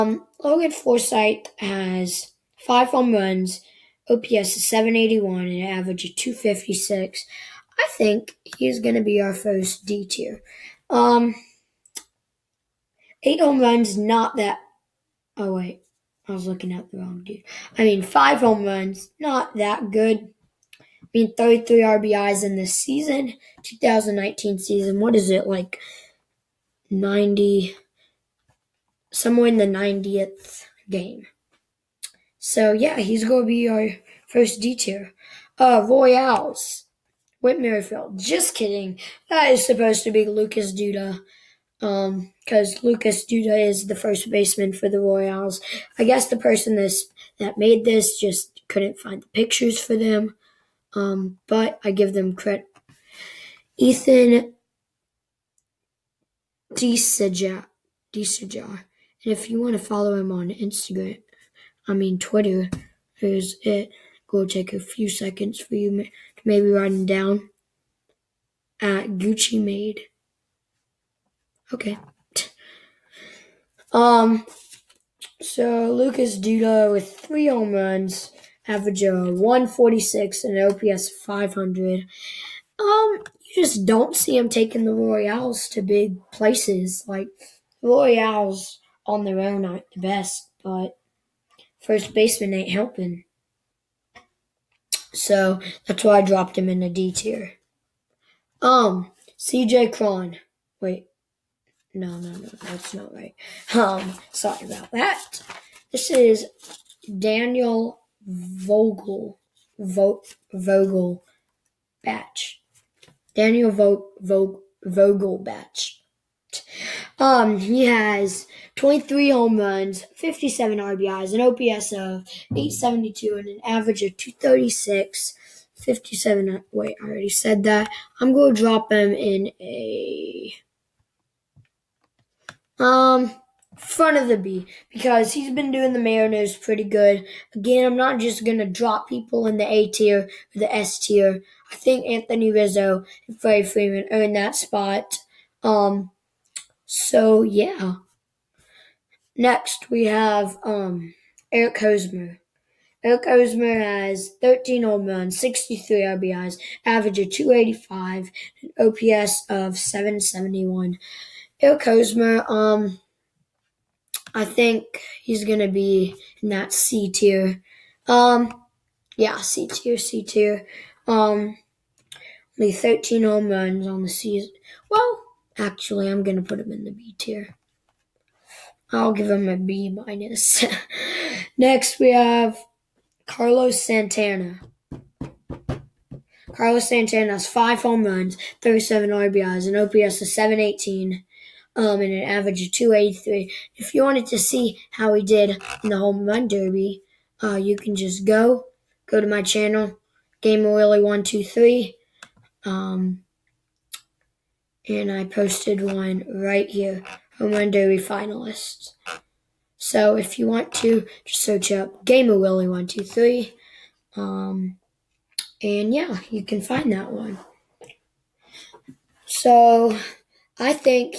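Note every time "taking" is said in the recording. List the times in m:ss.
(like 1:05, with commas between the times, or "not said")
1:24.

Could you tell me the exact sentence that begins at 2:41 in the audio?
Eric Hosmer, um, I think he's gonna be in that C tier.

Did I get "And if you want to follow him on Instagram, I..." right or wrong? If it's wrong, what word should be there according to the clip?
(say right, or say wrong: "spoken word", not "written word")
right.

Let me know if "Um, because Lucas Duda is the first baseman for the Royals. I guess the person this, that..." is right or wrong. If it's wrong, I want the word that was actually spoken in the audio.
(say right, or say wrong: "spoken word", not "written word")
right.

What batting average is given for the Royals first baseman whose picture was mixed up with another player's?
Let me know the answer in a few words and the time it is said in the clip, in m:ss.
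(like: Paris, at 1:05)
146, at 1:19.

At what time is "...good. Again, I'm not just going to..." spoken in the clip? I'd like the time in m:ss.
2:16.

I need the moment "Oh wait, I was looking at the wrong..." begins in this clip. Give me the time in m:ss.
0:15.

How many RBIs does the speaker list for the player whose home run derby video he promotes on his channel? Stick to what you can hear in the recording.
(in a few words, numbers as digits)
37.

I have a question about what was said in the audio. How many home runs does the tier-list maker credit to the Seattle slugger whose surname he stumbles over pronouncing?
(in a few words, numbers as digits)
23.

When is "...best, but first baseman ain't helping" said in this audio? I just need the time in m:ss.
1:29.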